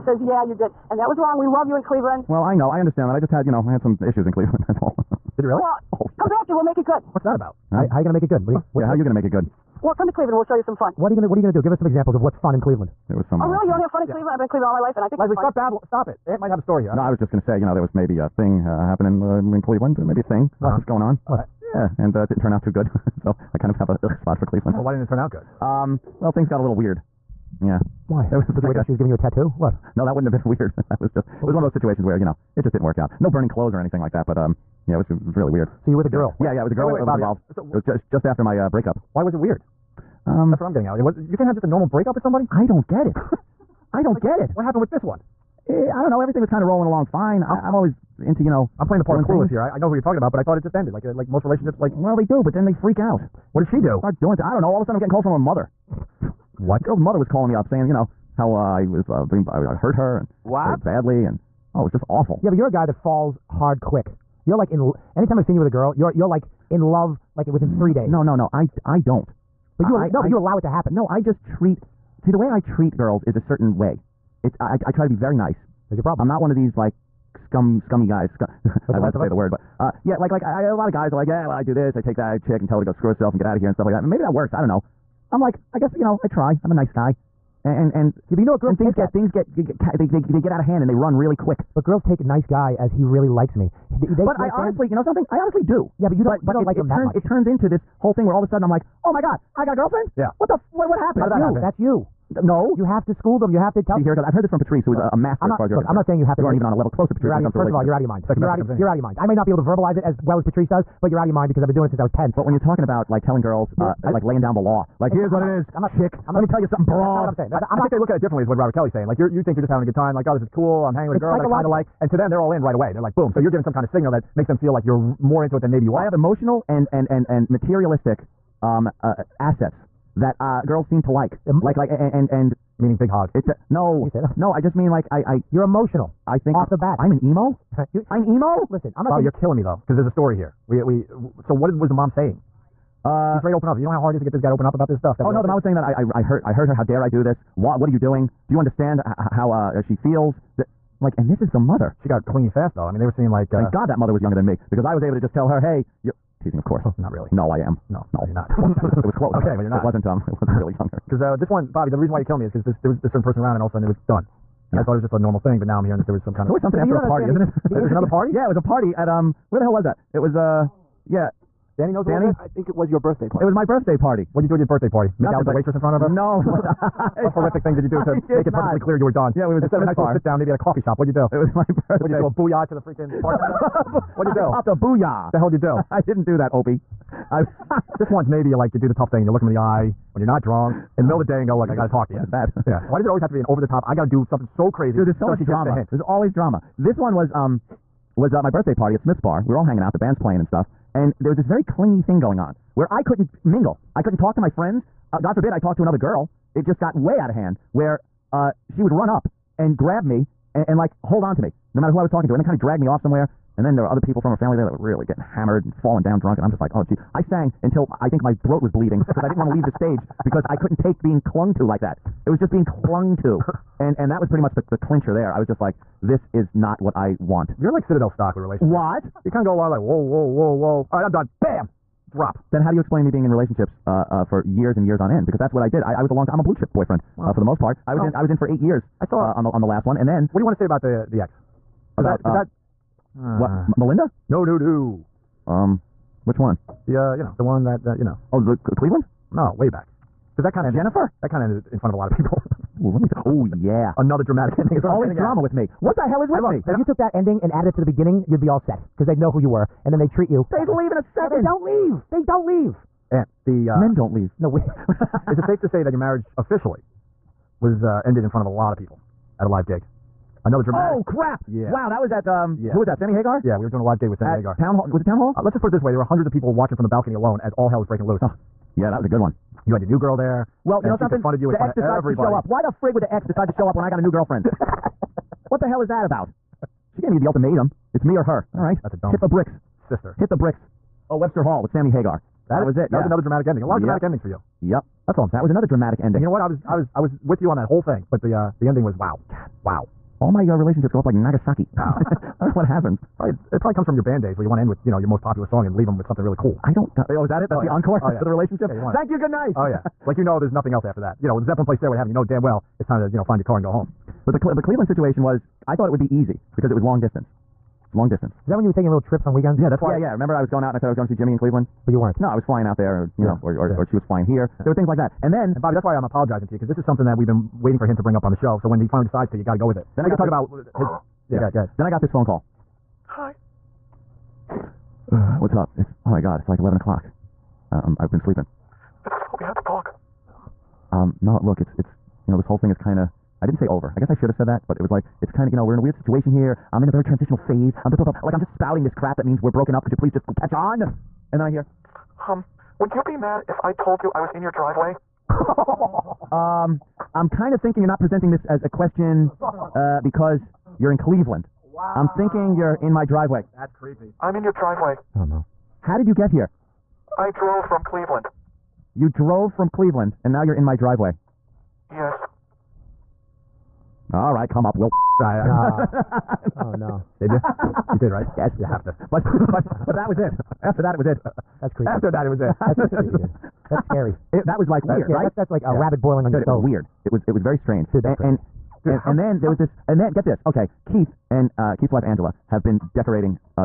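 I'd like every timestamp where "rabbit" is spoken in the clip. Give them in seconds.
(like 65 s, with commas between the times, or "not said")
385 s.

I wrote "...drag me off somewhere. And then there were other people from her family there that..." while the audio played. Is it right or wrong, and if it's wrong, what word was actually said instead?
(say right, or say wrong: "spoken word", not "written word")
right.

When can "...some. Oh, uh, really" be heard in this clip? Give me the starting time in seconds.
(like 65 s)
13 s.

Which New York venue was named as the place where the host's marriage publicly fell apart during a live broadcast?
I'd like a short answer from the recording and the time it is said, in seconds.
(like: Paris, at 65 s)
Webster Hall, at 291 s.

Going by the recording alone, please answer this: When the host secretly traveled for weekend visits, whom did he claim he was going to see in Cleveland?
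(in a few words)
Jimmy.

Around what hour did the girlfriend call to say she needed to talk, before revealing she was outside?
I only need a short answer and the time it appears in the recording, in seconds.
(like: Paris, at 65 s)
11 o'clock, at 336 s.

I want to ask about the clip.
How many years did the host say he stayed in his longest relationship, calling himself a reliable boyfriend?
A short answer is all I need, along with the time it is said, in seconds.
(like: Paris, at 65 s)
8, at 238 s.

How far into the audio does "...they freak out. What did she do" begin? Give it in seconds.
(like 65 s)
52 s.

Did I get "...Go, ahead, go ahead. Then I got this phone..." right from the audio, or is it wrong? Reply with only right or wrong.
right.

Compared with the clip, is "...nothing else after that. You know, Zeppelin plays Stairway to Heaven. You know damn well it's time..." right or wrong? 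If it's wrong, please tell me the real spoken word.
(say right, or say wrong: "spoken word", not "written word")
right.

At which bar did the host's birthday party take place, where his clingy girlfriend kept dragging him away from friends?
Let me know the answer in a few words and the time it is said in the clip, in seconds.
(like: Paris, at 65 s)
Smith's Bar, at 198 s.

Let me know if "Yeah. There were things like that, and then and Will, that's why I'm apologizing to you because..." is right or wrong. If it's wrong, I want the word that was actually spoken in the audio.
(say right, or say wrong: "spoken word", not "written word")
wrong: "Bobby", not "Will".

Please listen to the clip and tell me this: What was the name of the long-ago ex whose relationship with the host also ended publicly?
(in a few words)
Jennifer.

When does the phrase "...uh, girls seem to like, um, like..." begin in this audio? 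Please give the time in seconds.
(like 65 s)
130 s.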